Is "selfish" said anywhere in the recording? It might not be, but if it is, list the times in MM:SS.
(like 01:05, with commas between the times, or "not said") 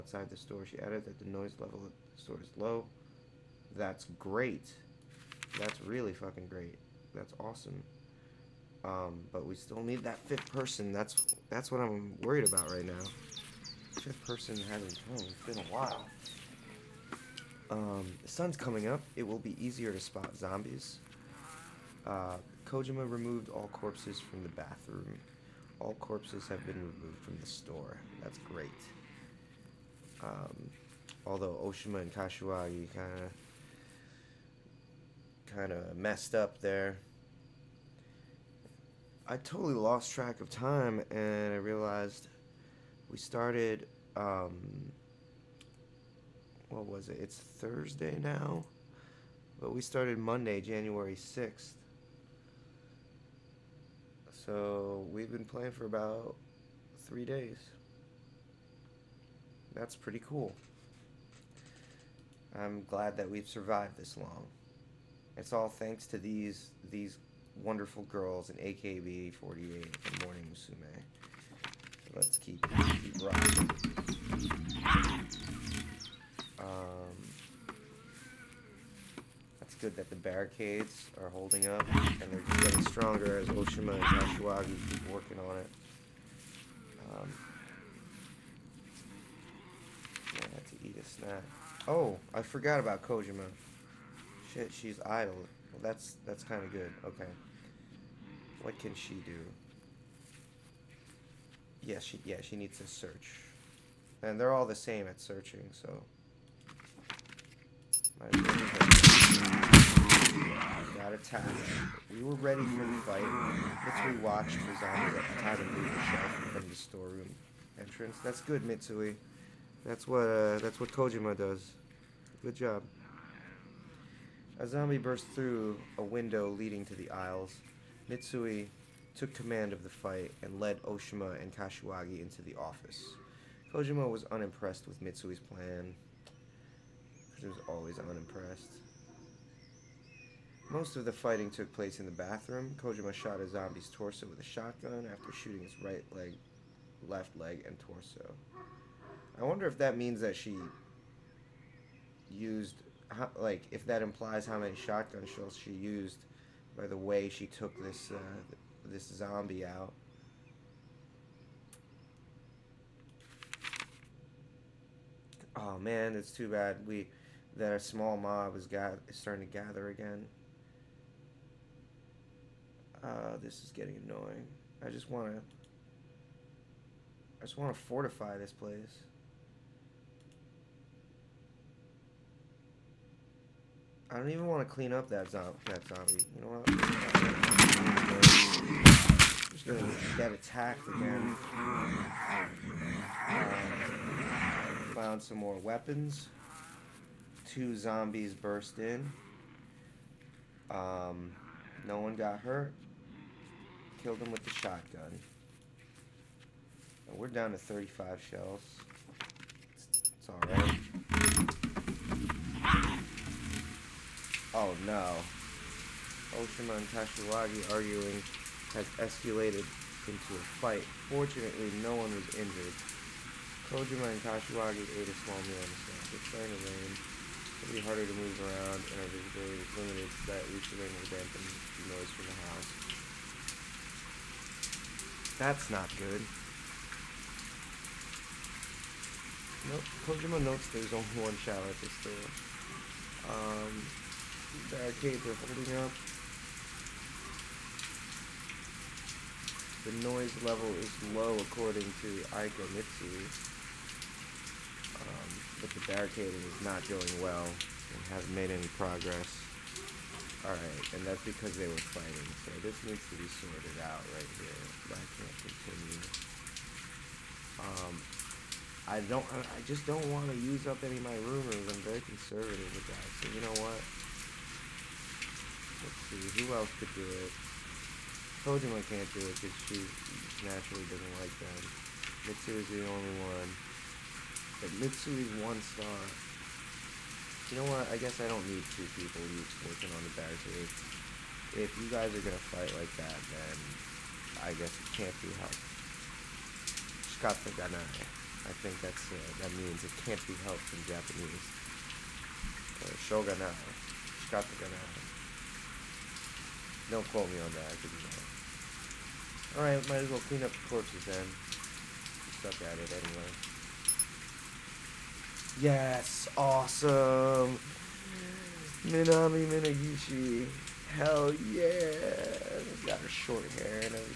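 not said.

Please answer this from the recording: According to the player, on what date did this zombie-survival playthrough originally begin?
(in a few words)
Monday, January 6th.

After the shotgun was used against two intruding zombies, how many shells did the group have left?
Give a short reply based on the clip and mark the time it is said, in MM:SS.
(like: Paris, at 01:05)
35, at 03:27.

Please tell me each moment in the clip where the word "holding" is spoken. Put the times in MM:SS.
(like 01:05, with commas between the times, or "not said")
01:21, 04:05.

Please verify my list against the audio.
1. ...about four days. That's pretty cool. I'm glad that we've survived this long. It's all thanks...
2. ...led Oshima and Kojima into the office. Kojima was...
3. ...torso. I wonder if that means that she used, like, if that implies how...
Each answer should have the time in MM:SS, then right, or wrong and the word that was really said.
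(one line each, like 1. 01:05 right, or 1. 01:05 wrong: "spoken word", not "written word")
1. 00:55 wrong: "three", not "four"
2. 02:10 wrong: "Kashiwagi", not "Kojima"
3. 02:27 right.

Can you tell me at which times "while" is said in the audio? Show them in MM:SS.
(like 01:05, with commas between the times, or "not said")
00:15.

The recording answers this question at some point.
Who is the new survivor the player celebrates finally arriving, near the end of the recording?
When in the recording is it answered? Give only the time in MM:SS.
05:18.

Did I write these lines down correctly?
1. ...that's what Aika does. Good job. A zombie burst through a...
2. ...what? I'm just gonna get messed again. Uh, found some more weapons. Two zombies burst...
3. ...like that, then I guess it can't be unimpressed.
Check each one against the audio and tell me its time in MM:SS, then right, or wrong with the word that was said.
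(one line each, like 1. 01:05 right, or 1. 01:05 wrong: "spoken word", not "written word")
1. 02:00 wrong: "Kojima", not "Aika"
2. 03:06 wrong: "attacked", not "messed"
3. 04:52 wrong: "helped", not "unimpressed".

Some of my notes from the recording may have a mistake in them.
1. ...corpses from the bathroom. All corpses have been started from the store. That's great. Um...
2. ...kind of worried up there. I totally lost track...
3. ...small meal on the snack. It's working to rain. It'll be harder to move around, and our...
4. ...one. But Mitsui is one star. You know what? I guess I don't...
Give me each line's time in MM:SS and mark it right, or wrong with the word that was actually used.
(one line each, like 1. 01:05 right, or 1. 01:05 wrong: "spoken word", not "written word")
1. 00:23 wrong: "removed", not "started"
2. 00:35 wrong: "messed", not "worried"
3. 03:45 wrong: "starting", not "working"
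4. 04:43 right.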